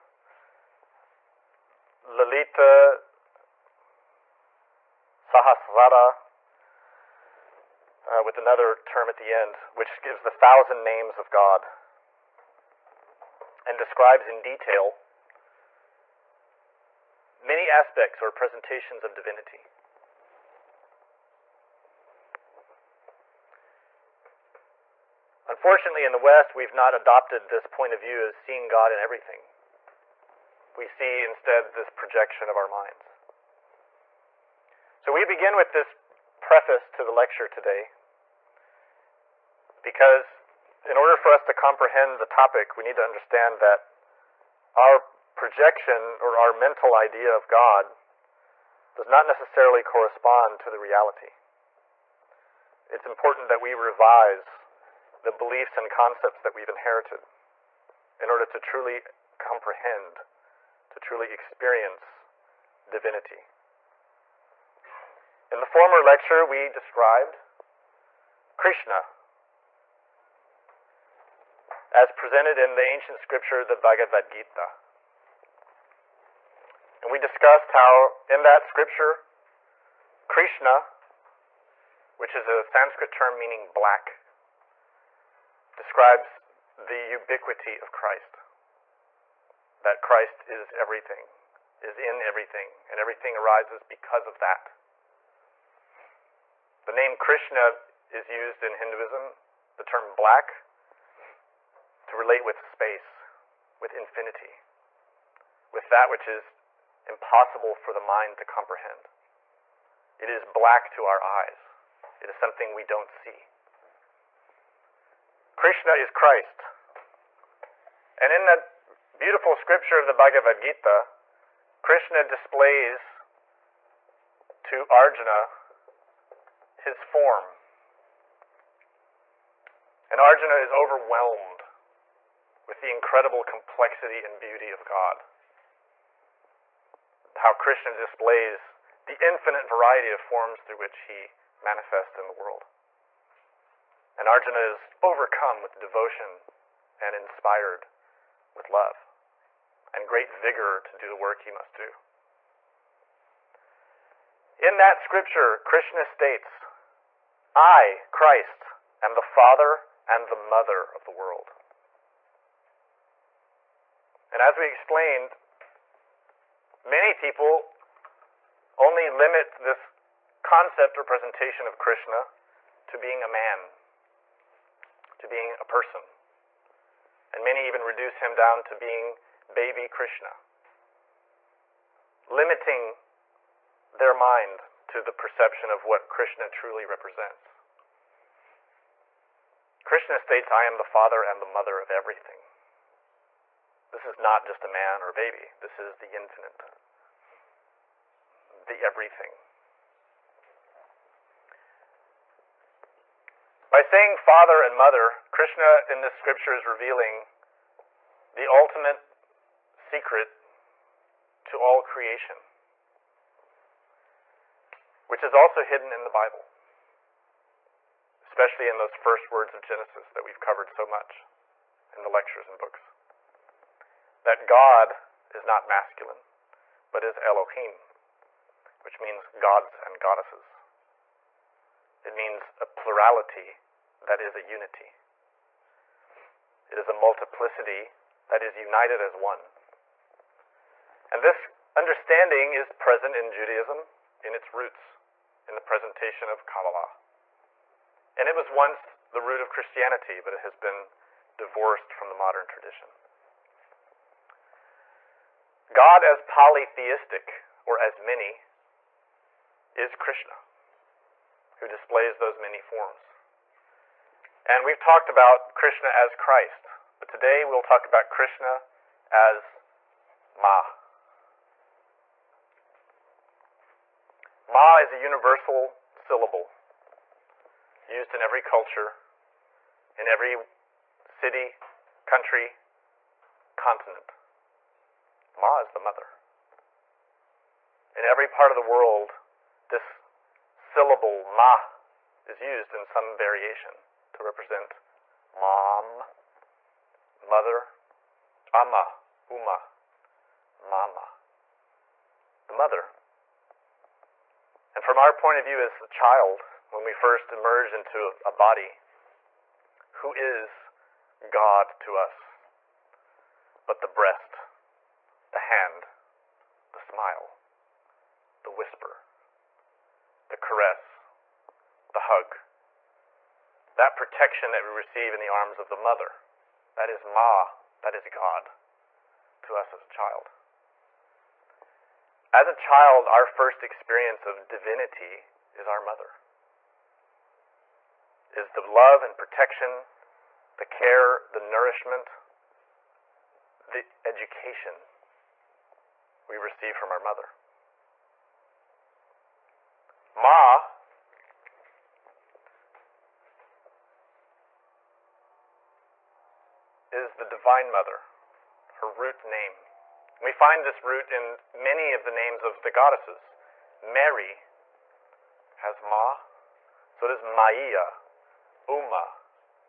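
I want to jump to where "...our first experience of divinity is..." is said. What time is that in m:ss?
5:33.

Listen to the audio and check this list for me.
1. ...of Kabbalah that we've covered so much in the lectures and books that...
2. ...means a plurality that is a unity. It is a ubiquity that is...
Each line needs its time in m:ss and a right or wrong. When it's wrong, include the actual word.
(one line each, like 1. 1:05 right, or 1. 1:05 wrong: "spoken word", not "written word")
1. 3:39 wrong: "Genesis", not "Kabbalah"
2. 3:52 wrong: "multiplicity", not "ubiquity".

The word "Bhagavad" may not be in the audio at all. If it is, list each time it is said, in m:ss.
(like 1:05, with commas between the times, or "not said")
1:13, 2:00.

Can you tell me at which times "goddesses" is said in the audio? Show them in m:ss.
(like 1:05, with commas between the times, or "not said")
3:50, 6:02.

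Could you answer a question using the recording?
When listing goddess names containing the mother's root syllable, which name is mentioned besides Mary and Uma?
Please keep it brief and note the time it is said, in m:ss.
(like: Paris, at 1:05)
Maia, at 6:07.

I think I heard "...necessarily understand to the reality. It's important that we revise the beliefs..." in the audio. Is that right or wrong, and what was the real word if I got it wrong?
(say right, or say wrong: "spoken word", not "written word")
wrong: "correspond", not "understand".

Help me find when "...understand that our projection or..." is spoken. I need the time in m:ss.
0:43.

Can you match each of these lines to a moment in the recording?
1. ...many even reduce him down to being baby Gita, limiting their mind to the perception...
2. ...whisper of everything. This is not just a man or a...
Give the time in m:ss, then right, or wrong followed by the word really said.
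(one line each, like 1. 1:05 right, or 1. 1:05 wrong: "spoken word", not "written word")
1. 2:57 wrong: "Krishna", not "Gita"
2. 3:11 wrong: "mother", not "whisper".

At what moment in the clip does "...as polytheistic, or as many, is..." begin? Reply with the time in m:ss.
4:16.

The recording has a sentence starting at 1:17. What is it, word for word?
And we discussed how in that scripture, Krishna, which is a Sanskrit term meaning black, describes the ubiquity of Christ.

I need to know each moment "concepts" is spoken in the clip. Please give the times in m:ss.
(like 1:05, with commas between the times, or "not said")
0:55, 2:50.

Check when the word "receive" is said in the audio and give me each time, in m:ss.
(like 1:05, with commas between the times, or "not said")
5:24, 5:46.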